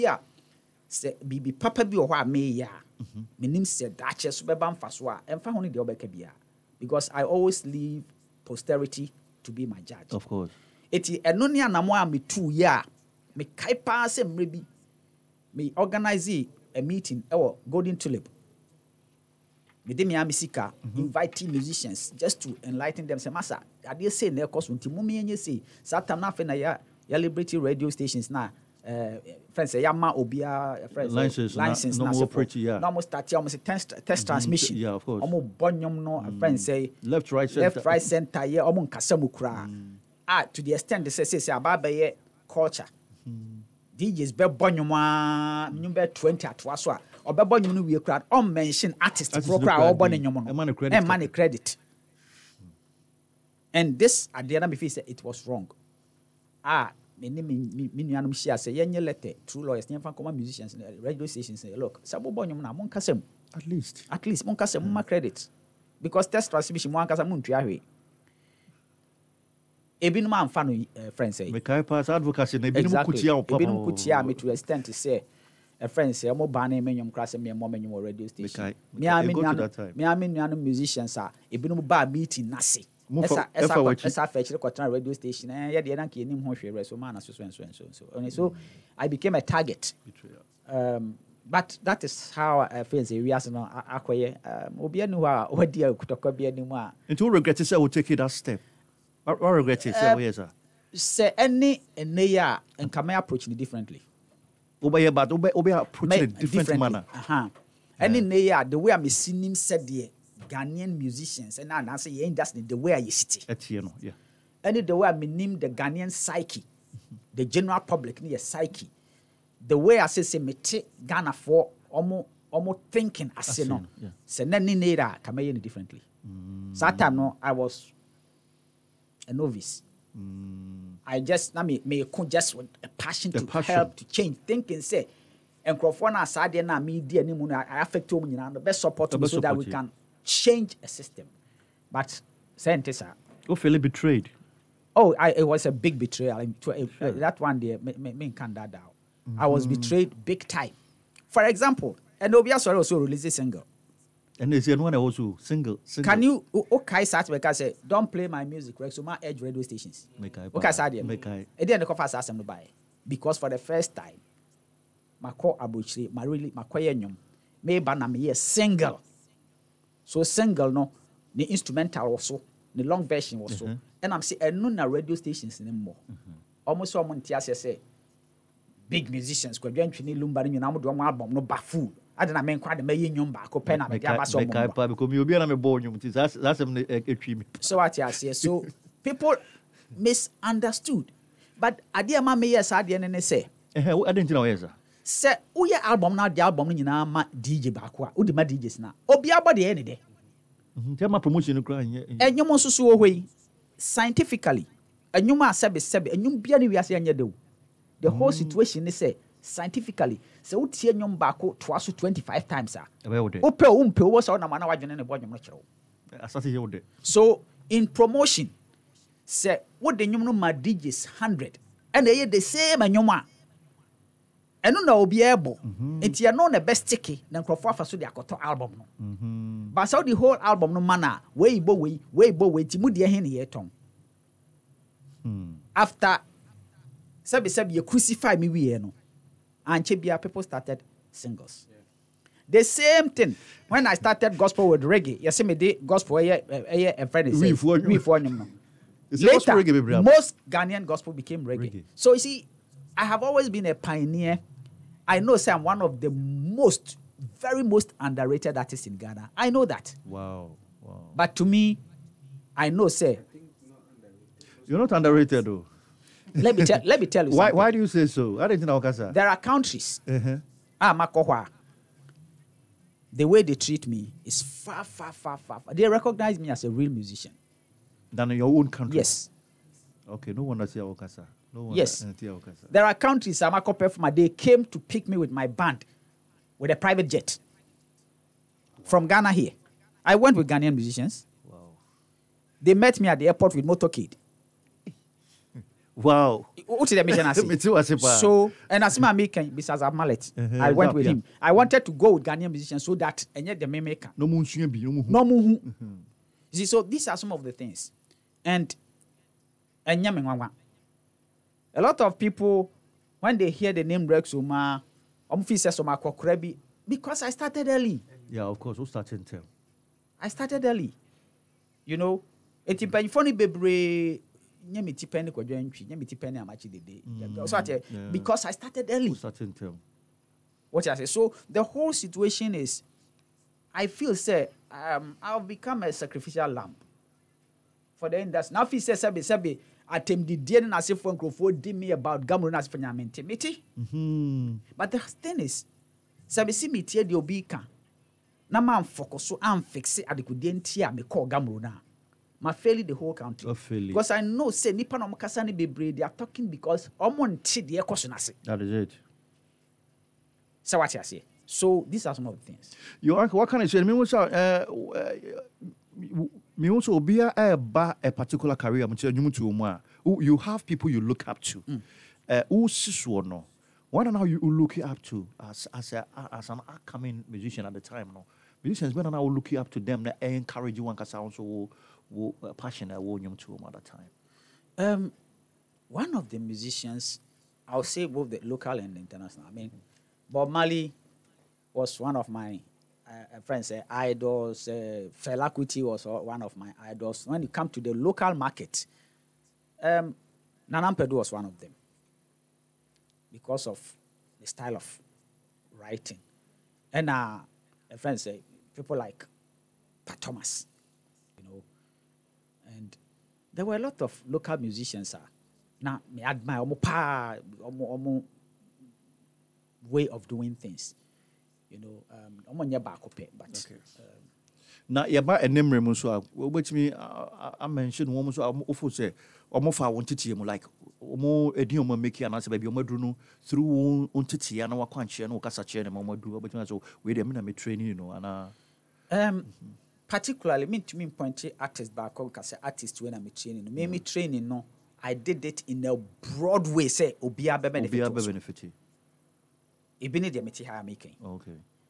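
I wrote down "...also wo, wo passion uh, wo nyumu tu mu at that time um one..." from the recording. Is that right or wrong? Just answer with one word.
right.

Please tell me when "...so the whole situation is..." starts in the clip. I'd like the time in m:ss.
5:31.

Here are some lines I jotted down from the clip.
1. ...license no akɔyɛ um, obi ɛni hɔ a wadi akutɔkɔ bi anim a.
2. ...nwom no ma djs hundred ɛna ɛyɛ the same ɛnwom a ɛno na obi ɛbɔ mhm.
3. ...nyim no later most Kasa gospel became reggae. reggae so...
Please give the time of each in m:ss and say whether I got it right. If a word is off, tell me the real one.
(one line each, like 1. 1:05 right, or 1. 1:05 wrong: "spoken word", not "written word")
1. 1:33 wrong: "wiase", not "license"
2. 3:40 right
3. 4:08 wrong: "Ghanaian", not "Kasa".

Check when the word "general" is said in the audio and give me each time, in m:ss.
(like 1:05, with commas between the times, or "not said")
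1:57.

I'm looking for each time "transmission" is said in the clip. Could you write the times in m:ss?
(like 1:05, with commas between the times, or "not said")
0:34, 1:06.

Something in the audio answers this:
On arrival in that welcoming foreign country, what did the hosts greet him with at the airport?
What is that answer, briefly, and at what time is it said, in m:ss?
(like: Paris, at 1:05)
Motorcade, at 4:53.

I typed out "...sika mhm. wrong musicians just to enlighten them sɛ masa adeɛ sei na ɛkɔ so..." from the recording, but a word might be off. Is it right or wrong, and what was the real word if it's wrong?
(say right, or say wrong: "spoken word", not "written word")
wrong: "inviting", not "wrong".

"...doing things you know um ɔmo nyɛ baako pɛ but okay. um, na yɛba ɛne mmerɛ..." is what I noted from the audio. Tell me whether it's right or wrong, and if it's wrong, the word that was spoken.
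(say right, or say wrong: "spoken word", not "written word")
right.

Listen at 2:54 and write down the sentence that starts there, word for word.
sɛ ɛno na radio stations ne mmɔ mm-hmm.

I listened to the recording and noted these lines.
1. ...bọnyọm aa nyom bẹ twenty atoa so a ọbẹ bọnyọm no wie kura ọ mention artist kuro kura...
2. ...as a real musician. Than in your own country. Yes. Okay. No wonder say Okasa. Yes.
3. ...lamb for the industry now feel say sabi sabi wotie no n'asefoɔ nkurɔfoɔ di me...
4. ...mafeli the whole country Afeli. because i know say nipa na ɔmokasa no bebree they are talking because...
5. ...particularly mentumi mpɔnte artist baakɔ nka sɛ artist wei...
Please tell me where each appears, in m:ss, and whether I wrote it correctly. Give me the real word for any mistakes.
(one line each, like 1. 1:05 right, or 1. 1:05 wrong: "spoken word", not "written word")
1. 0:44 right
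2. 4:36 right
3. 5:36 wrong: "atɛmdidie", not "wotie"
4. 5:52 right
5. 7:20 right.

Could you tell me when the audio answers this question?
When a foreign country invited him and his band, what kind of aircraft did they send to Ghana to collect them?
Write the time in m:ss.
4:46.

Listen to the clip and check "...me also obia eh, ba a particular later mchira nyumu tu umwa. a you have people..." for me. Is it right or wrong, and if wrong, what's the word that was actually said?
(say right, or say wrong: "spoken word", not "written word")
wrong: "career", not "later".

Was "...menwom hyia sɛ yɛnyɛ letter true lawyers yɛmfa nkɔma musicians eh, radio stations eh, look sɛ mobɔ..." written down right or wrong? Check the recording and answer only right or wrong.
wrong.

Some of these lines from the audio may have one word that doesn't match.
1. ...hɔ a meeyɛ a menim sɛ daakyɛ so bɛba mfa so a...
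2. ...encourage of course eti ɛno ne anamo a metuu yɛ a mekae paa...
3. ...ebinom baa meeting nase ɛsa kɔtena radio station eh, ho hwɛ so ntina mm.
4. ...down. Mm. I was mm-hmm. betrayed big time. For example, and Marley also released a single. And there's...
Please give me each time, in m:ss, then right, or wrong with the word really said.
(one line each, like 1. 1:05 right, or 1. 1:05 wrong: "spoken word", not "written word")
1. 0:02 right
2. 0:09 wrong: "judge", not "encourage"
3. 1:21 wrong: "maana", not "ntina"
4. 2:28 wrong: "Sore", not "Marley".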